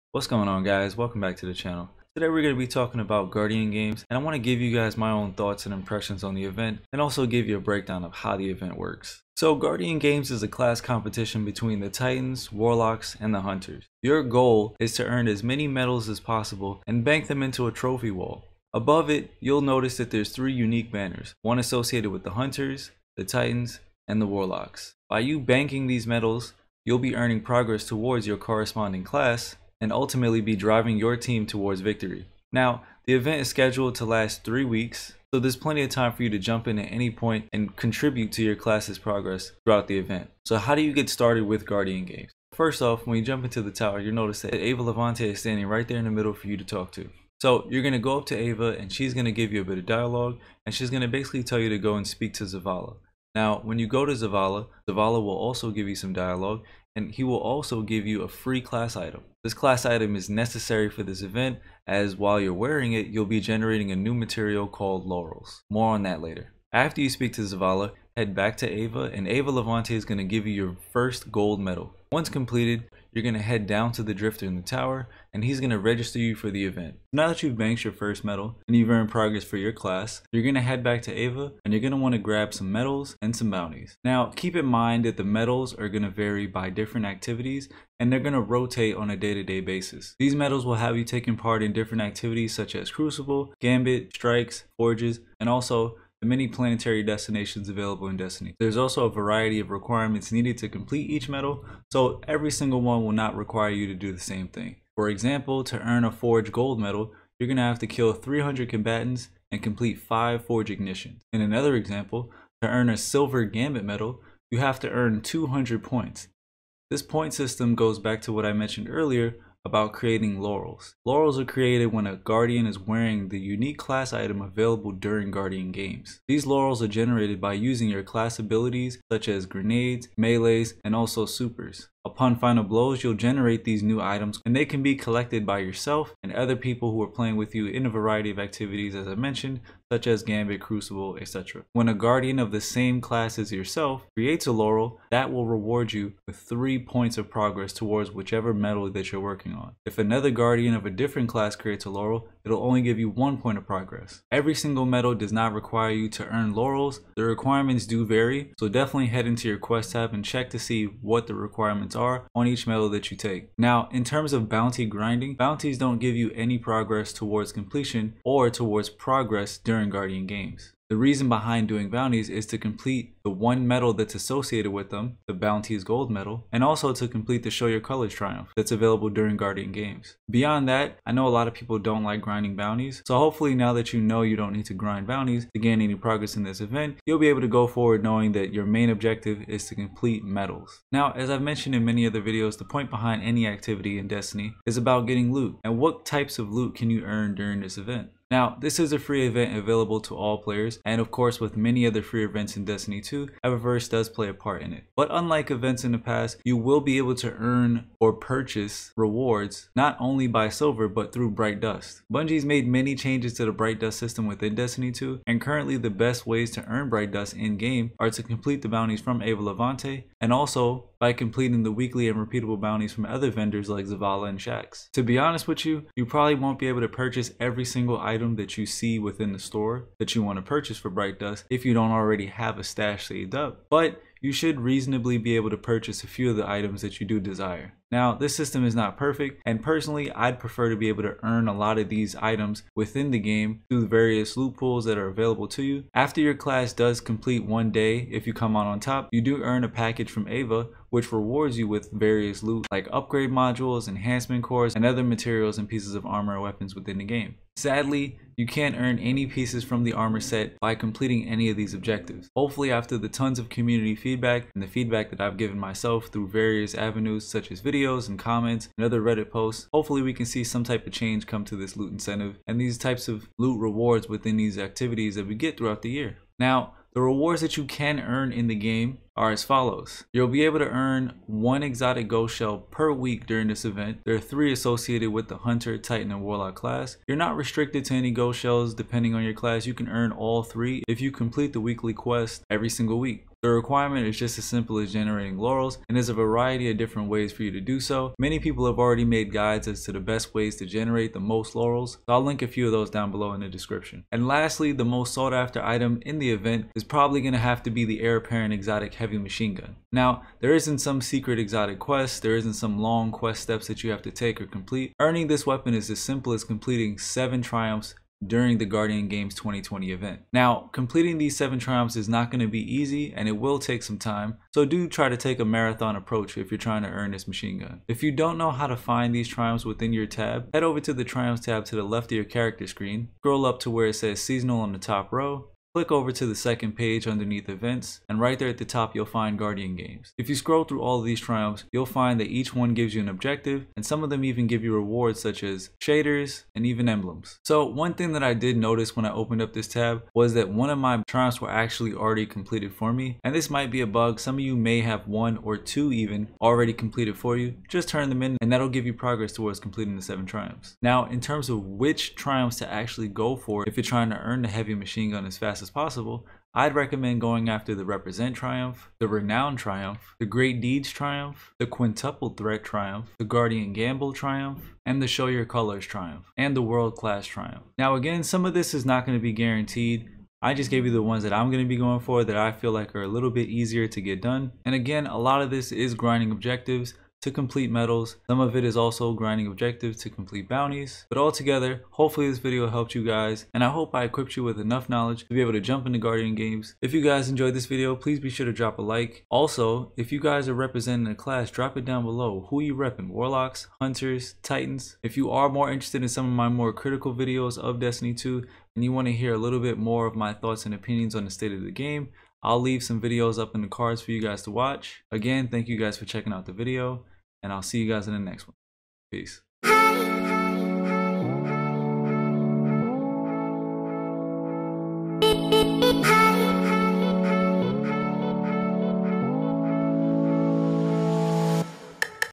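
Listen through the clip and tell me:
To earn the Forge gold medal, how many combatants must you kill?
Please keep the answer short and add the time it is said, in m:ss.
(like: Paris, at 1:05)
300, at 1:48.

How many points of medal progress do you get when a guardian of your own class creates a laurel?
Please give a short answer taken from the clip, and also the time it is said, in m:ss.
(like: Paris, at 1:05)
3, at 2:26.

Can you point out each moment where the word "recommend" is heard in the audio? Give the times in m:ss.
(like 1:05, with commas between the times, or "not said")
6:06.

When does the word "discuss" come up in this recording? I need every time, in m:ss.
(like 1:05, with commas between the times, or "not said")
not said.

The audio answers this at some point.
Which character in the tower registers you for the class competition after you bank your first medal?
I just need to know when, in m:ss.
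1:14.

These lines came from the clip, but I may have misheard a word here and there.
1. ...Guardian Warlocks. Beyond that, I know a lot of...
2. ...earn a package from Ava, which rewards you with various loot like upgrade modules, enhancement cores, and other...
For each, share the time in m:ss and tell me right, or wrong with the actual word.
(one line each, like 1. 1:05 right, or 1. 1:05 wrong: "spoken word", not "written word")
1. 2:59 wrong: "Games", not "Warlocks"
2. 4:09 right.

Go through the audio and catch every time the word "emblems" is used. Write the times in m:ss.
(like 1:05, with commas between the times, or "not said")
5:46.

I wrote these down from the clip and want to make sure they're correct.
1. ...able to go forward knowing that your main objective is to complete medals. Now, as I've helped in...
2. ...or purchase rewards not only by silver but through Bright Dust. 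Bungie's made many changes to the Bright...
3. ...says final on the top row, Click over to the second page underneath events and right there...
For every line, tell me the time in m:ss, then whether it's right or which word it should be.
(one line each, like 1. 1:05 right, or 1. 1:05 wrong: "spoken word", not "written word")
1. 3:07 wrong: "mentioned", not "helped"
2. 3:27 right
3. 5:33 wrong: "seasonal", not "final".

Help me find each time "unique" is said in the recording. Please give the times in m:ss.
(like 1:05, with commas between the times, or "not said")
0:20, 2:03.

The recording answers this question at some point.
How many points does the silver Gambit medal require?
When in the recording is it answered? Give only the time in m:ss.
1:55.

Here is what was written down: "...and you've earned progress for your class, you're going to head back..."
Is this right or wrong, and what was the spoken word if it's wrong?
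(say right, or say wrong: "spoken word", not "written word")
right.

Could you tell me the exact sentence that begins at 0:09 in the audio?
So Guardian Games is a class competition between the Titans, Warlocks, and the Hunters.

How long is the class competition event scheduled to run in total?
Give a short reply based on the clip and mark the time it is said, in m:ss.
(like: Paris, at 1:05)
3 weeks, at 0:34.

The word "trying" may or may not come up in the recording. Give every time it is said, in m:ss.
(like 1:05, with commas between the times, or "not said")
5:26, 6:03.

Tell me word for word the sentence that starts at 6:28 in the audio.
Some of it is also grinding objectives to complete bounties.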